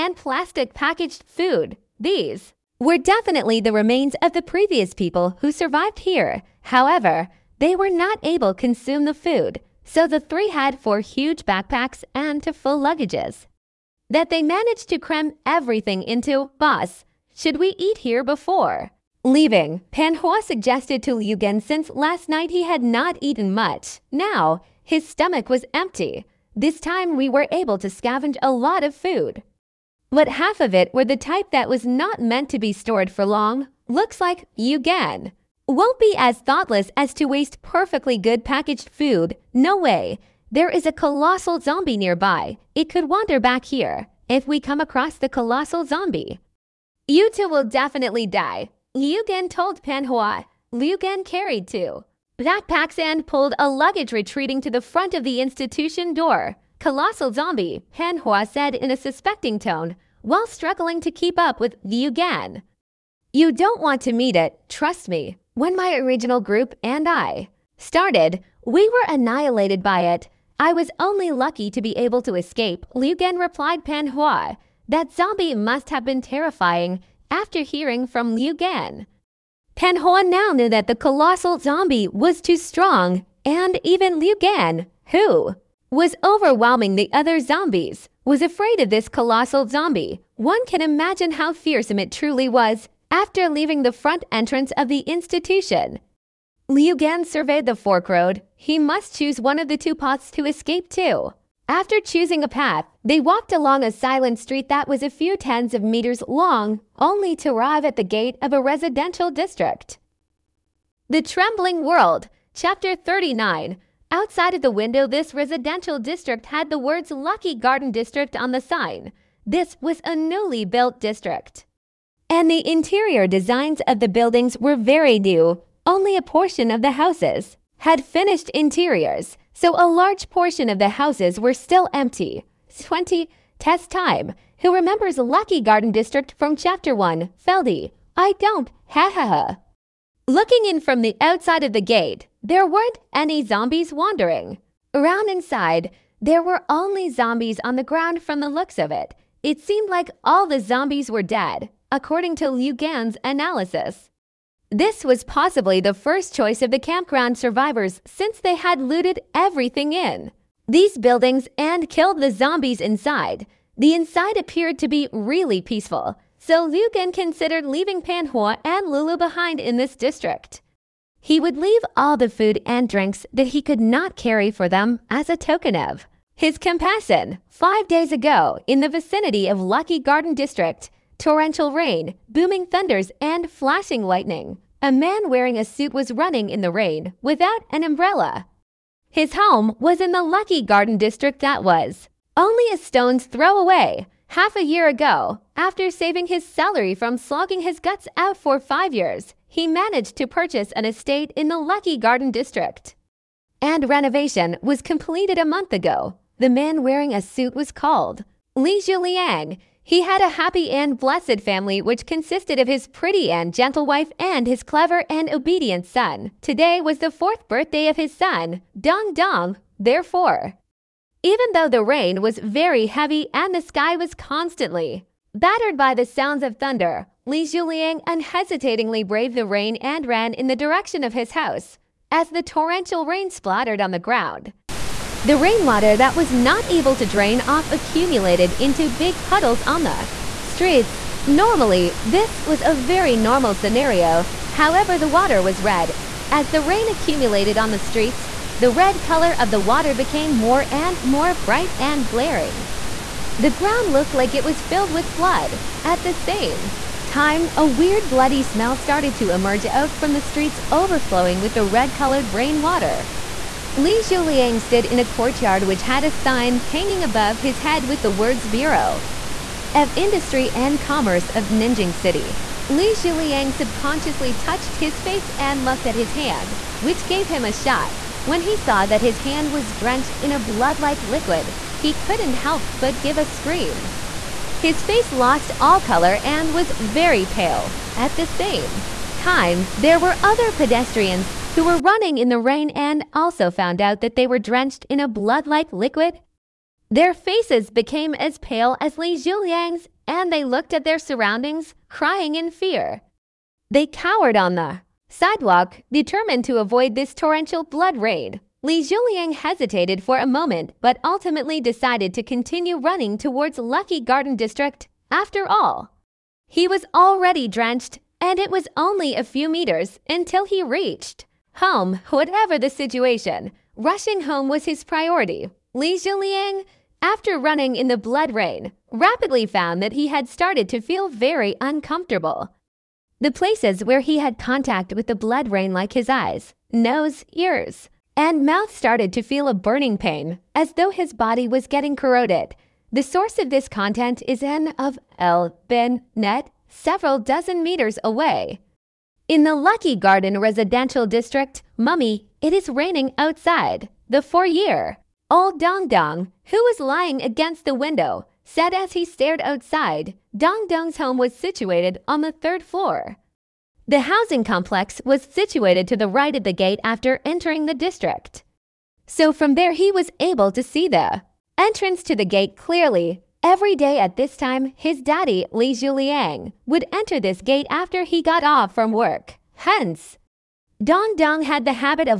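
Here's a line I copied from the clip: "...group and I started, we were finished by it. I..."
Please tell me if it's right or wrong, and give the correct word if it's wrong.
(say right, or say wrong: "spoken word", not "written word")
wrong: "annihilated", not "finished".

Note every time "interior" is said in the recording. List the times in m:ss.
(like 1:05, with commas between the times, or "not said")
2:02, 2:08.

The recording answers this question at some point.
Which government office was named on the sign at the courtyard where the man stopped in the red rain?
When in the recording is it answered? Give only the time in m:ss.
4:28.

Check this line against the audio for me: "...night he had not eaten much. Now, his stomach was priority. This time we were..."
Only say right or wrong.
wrong.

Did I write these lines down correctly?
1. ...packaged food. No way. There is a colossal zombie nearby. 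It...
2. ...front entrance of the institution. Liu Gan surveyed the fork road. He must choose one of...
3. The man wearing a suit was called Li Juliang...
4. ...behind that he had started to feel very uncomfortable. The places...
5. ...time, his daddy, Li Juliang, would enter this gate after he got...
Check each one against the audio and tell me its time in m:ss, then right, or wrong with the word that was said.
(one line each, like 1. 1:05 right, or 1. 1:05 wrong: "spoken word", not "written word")
1. 0:38 right
2. 1:33 right
3. 3:26 right
4. 5:29 wrong: "found", not "behind"
5. 6:14 right.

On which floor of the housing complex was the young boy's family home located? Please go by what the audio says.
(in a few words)
Third floor.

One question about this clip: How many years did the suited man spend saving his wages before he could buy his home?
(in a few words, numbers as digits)
5.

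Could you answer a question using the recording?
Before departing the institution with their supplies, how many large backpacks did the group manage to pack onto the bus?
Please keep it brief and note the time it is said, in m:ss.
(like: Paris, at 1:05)
4, at 0:10.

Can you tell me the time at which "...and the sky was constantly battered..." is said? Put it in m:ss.
3:43.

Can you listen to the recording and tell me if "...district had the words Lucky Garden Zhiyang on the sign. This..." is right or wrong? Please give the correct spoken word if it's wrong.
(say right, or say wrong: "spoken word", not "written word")
wrong: "District", not "Zhiyang".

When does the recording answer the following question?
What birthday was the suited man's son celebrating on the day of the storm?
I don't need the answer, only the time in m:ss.
3:37.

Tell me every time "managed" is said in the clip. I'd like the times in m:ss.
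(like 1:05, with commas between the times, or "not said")
0:14, 3:19.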